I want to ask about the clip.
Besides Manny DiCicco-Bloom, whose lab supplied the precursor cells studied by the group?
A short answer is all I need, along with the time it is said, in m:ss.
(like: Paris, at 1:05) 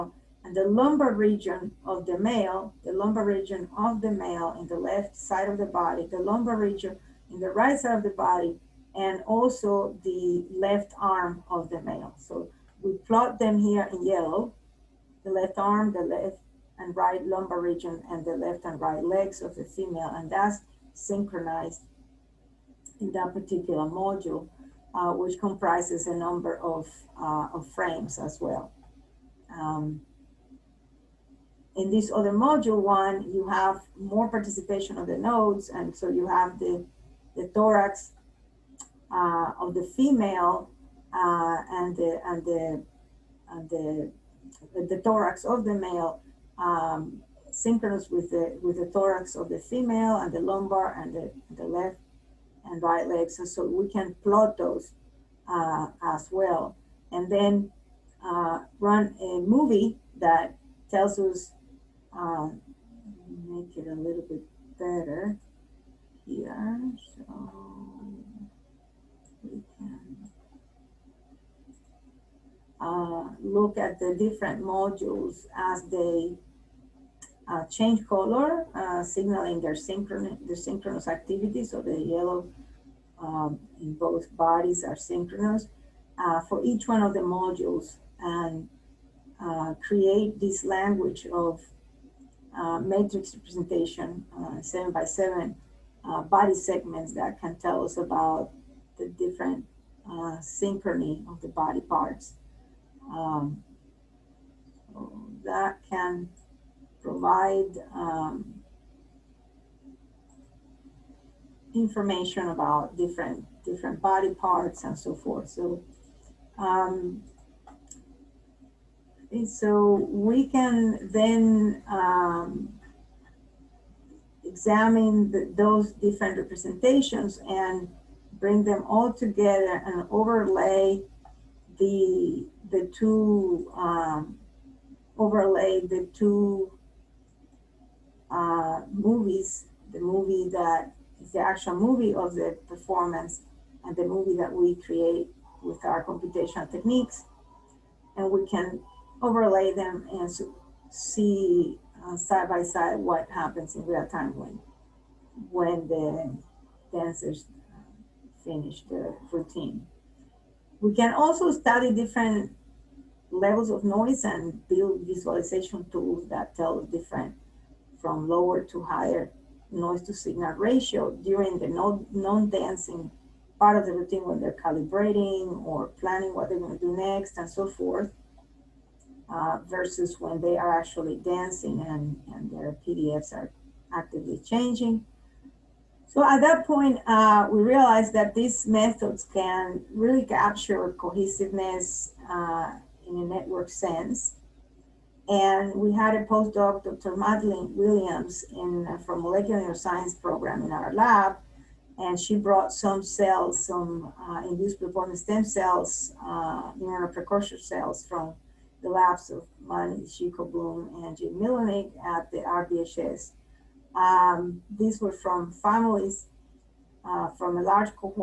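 Jim Millonig, at 3:31.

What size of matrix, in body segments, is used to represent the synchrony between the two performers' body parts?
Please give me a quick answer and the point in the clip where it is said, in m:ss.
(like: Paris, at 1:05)
7 by 7, at 1:34.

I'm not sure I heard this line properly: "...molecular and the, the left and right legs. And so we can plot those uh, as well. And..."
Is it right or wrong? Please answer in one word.
wrong.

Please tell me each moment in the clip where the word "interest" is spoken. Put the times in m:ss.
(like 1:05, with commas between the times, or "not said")
not said.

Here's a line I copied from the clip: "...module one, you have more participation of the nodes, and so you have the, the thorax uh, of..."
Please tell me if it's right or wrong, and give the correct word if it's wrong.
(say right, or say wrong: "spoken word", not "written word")
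right.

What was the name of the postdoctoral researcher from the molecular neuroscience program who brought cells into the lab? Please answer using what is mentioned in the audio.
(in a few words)
Dr. Madeline Williams.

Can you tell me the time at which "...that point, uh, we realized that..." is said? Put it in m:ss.
3:06.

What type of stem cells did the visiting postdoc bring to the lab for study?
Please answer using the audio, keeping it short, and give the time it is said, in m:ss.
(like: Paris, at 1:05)
induced pluripotent stem cells, at 3:24.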